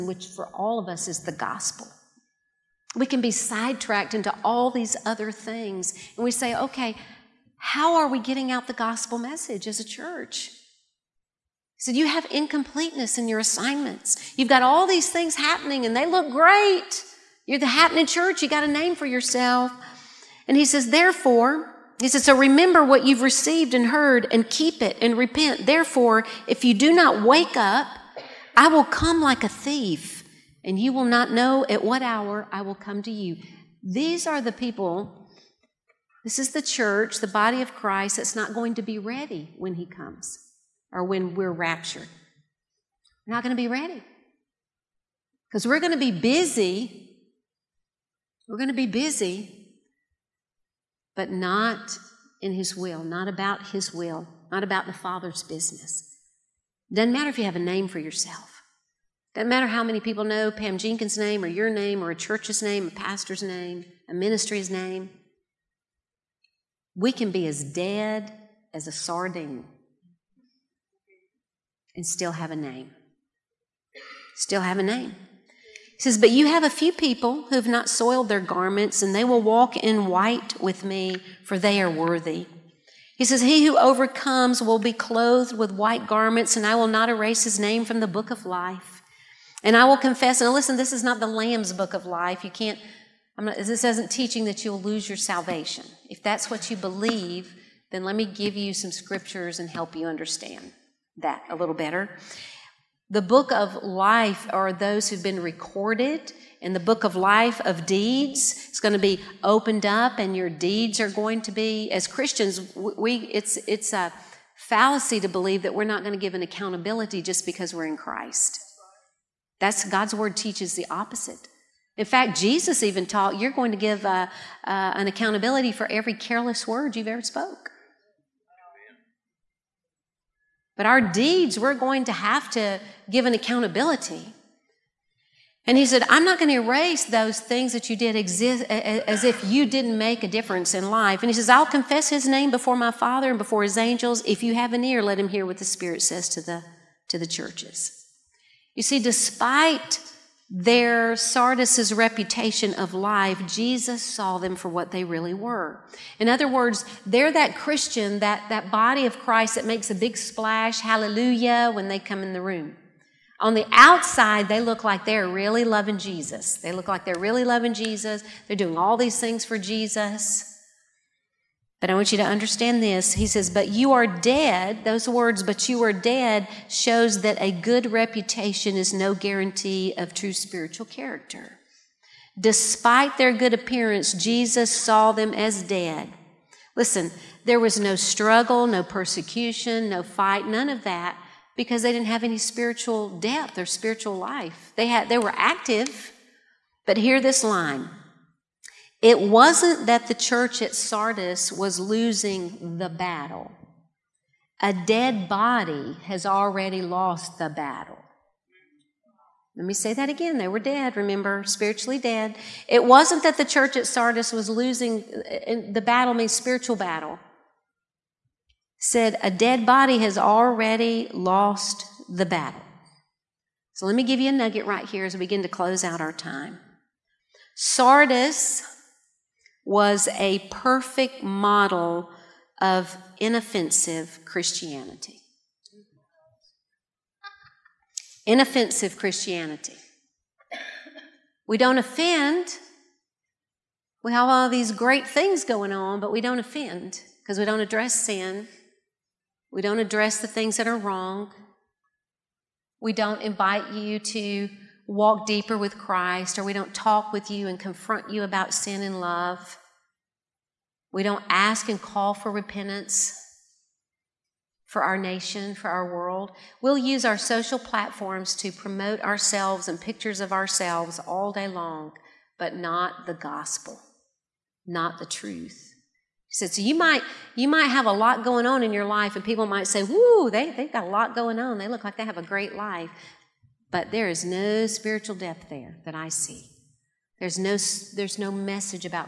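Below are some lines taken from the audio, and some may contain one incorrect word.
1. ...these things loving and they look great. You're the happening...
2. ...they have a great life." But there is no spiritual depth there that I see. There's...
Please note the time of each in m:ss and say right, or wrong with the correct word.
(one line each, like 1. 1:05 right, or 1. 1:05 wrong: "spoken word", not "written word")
1. 0:14 wrong: "happening", not "loving"
2. 4:41 right.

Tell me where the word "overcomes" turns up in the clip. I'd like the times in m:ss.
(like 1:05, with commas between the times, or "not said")
1:23.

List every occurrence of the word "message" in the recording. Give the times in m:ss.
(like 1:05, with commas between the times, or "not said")
0:09, 4:48.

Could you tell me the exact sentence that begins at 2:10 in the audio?
But our deeds, we're going to have to give an accountability.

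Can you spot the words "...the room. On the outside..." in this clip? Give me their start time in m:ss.
2:42.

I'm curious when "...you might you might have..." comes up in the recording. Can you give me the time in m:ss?
4:36.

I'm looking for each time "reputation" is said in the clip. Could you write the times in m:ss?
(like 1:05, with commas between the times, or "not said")
2:31, 2:57.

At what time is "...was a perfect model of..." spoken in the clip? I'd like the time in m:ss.
3:49.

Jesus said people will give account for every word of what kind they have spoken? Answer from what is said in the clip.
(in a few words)
Careless.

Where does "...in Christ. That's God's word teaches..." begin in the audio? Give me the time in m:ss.
1:57.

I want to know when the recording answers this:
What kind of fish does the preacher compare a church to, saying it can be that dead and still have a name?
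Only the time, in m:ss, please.
1:08.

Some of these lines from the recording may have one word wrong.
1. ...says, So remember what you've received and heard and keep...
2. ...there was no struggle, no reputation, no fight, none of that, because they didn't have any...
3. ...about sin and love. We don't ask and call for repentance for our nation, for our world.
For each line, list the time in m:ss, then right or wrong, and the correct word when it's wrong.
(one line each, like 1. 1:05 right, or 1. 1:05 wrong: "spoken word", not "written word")
1. 0:22 right
2. 3:07 wrong: "persecution", not "reputation"
3. 4:18 right.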